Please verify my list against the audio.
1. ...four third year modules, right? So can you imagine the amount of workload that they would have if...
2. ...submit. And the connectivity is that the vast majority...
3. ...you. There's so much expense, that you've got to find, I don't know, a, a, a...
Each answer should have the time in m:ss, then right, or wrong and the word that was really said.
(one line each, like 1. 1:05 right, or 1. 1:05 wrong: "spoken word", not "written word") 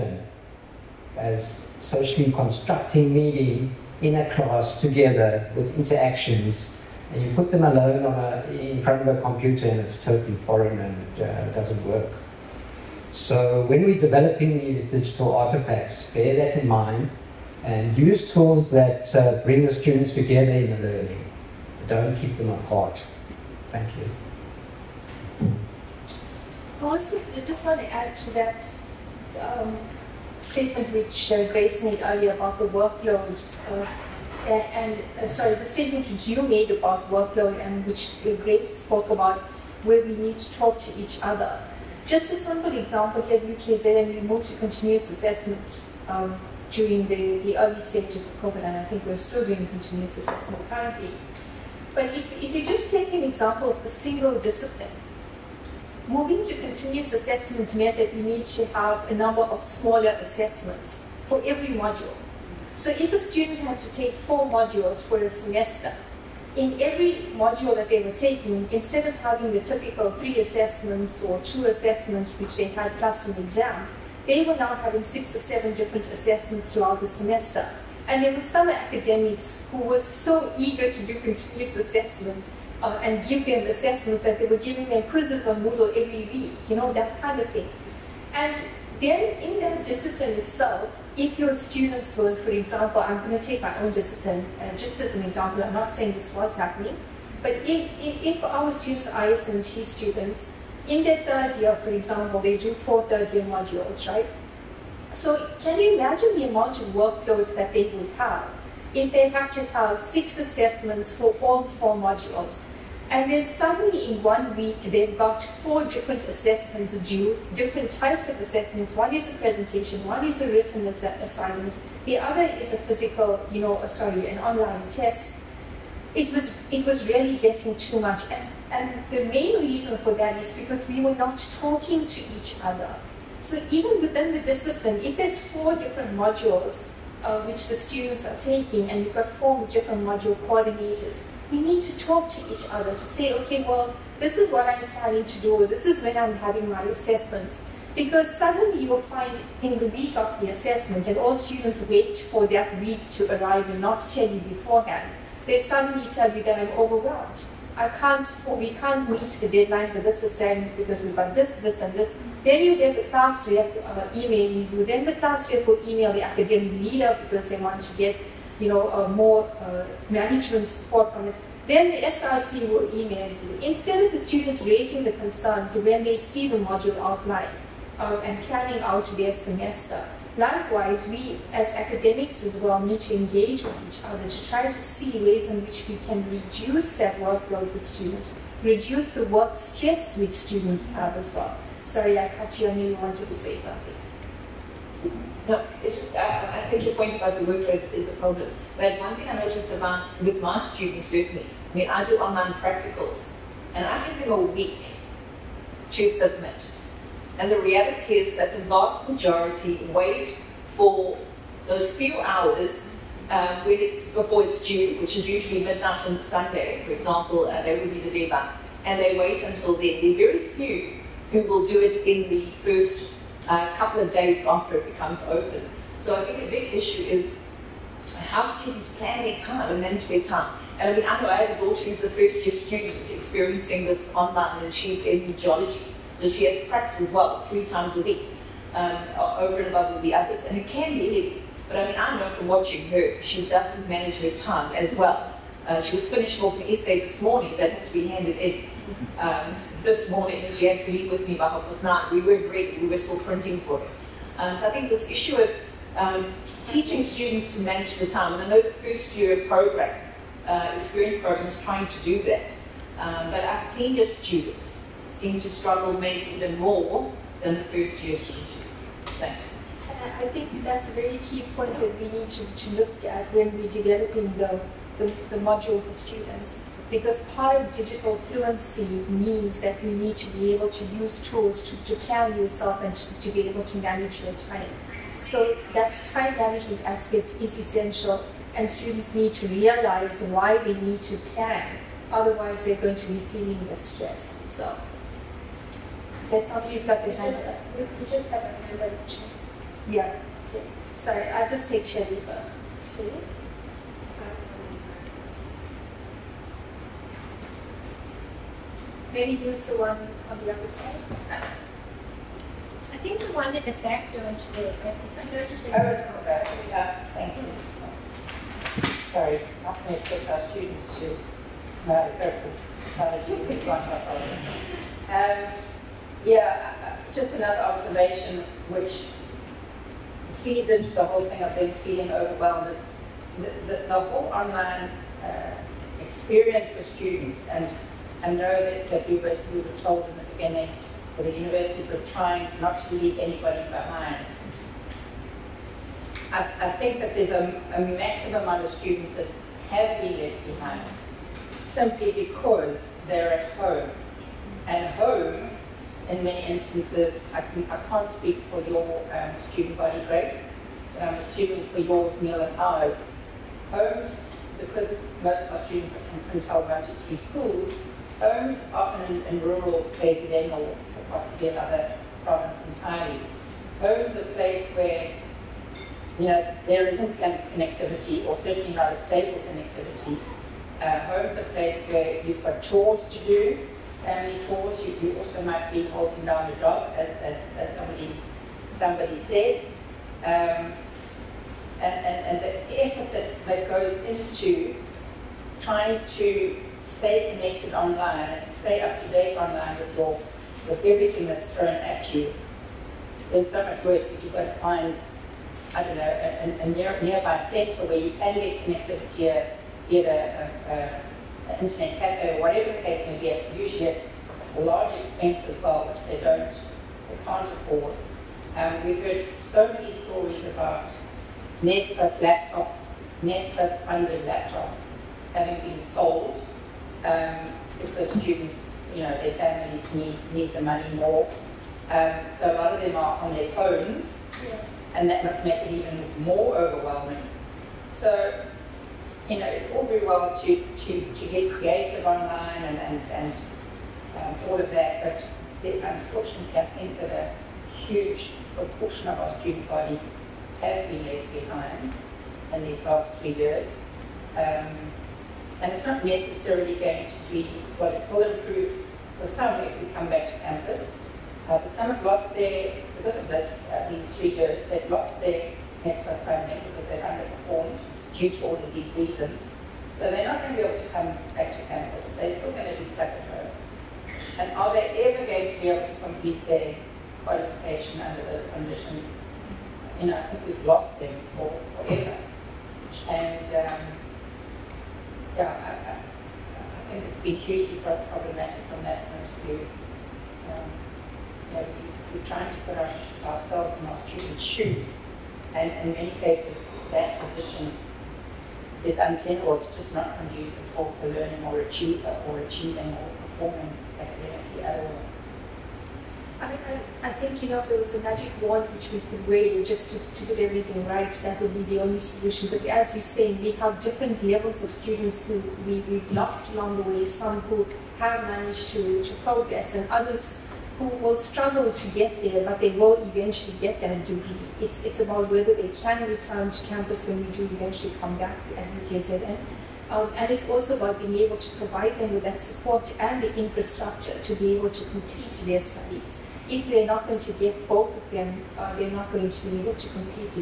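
1. 1:42 right
2. 3:26 wrong: "reality", not "connectivity"
3. 6:42 wrong: "worse", not "expense".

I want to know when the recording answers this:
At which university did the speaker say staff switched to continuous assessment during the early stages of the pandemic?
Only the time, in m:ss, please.
0:43.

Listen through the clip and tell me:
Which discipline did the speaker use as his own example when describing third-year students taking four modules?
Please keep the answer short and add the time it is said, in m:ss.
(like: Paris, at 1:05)
ISMT, at 1:39.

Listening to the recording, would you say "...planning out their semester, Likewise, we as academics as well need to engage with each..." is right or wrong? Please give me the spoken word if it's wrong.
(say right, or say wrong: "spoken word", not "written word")
right.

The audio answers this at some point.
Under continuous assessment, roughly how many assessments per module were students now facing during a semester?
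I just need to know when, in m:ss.
1:15.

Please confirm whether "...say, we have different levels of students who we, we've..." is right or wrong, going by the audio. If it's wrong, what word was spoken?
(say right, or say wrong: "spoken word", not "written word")
right.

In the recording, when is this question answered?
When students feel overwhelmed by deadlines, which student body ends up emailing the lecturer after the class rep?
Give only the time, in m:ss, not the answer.
2:52.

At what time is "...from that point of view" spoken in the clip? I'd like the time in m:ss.
8:08.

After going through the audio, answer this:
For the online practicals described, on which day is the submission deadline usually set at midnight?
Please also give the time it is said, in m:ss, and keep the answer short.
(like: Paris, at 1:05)
Sunday, at 3:36.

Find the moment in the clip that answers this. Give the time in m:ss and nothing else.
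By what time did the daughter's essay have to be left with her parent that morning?
4:11.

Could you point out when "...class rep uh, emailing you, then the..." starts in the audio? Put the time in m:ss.
2:43.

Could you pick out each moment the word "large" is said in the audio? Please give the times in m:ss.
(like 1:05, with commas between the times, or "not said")
6:54.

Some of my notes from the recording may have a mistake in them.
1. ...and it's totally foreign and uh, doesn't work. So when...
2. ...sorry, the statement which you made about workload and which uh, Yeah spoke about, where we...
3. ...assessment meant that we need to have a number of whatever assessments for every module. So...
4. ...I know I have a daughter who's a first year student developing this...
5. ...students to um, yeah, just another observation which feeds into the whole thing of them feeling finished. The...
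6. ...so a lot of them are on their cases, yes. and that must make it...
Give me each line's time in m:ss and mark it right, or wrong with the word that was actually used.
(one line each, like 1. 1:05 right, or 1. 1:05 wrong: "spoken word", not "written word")
1. 0:09 right
2. 0:35 wrong: "Grace", not "Yeah"
3. 0:57 wrong: "smaller", not "whatever"
4. 3:51 wrong: "experiencing", not "developing"
5. 5:20 wrong: "overwhelmed", not "finished"
6. 7:12 wrong: "phones", not "cases".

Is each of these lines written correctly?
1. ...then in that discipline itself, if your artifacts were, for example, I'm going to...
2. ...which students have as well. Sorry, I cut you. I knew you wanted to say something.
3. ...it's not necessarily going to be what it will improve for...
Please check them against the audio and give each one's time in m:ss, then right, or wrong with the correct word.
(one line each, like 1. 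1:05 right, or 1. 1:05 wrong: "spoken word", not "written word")
1. 1:29 wrong: "students", not "artifacts"
2. 3:10 right
3. 7:35 right.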